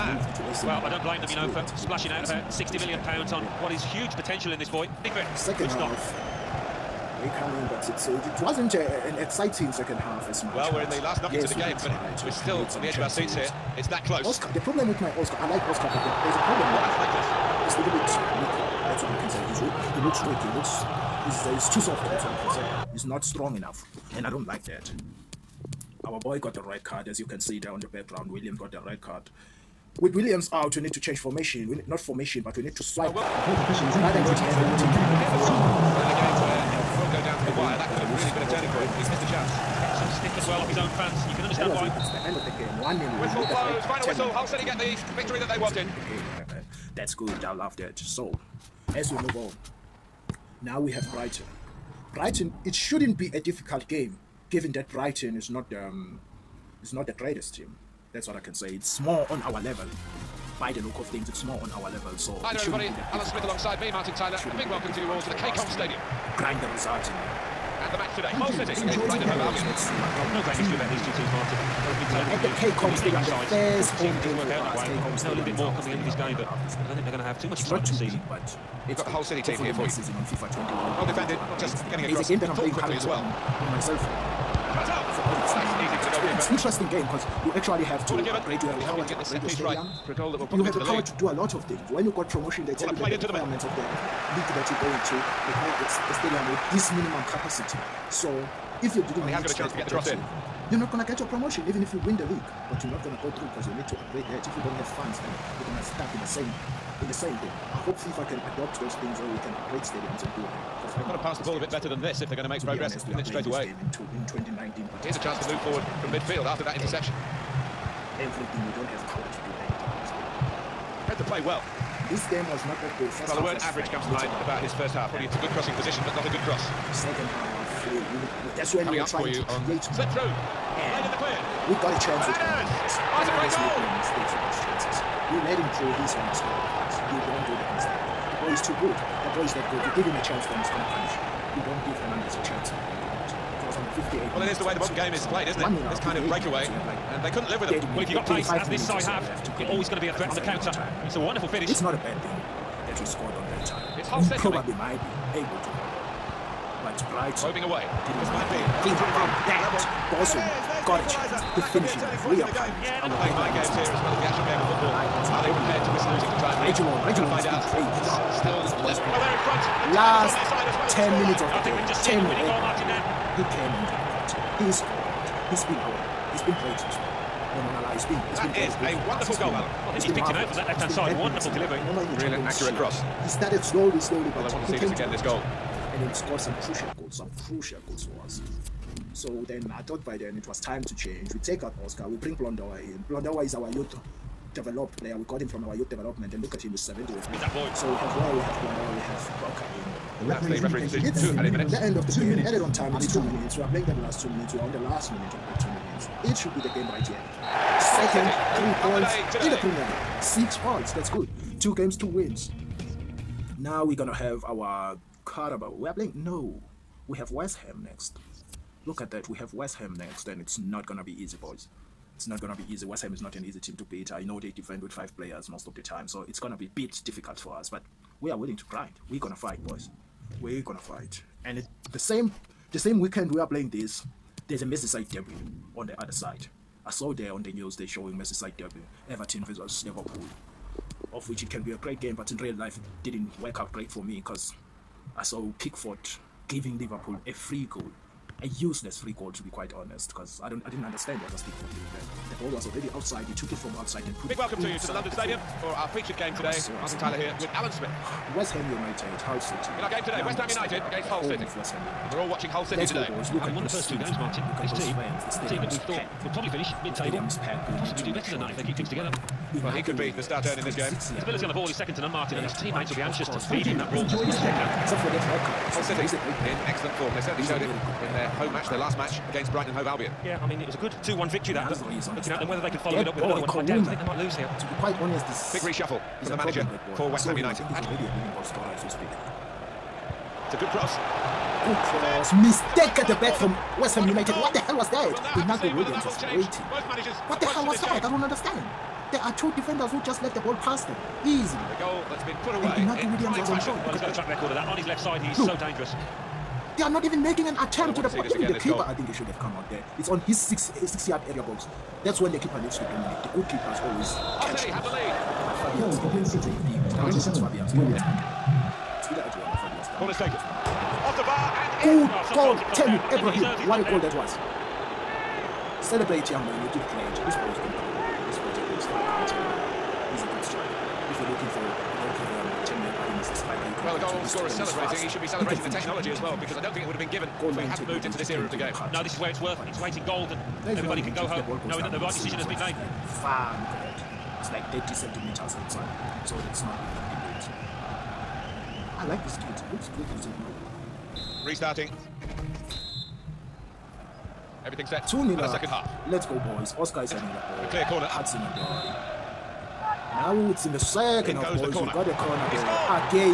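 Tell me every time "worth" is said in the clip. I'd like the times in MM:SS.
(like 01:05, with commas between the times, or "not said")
05:39.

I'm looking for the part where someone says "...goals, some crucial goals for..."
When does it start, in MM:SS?
03:06.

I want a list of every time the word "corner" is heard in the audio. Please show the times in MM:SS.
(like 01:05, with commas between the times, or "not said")
05:19, 05:57, 06:02.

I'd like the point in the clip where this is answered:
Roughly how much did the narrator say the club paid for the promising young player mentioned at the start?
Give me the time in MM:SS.
00:02.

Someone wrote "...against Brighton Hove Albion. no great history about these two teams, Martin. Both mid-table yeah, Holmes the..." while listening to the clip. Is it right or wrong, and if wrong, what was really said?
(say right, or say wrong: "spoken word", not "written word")
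right.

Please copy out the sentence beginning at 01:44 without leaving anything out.
If you don't have funds, then you're gonna stuck in the same in the same thing.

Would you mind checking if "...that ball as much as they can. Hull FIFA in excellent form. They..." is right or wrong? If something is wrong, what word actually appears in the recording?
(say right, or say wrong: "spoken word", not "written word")
wrong: "City", not "FIFA".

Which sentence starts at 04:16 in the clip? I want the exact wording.
Martin Tyler here with Alan Smith.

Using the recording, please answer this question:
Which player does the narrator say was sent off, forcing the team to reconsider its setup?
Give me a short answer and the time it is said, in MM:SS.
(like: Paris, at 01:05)
William, at 00:28.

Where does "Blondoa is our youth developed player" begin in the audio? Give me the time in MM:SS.
03:13.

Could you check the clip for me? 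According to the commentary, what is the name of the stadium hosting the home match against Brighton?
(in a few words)
KCOM Stadium.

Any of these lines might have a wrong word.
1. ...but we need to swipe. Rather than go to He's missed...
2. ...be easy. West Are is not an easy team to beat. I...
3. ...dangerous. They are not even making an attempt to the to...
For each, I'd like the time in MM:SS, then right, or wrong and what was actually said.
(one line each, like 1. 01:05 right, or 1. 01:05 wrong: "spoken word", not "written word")
1. 00:32 right
2. 03:42 wrong: "Ham", not "Are"
3. 05:05 right.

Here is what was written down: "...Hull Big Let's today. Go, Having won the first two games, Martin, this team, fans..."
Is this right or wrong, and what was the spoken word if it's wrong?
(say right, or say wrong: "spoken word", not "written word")
wrong: "City", not "Big".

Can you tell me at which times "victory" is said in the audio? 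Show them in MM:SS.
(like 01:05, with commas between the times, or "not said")
00:45, 04:41.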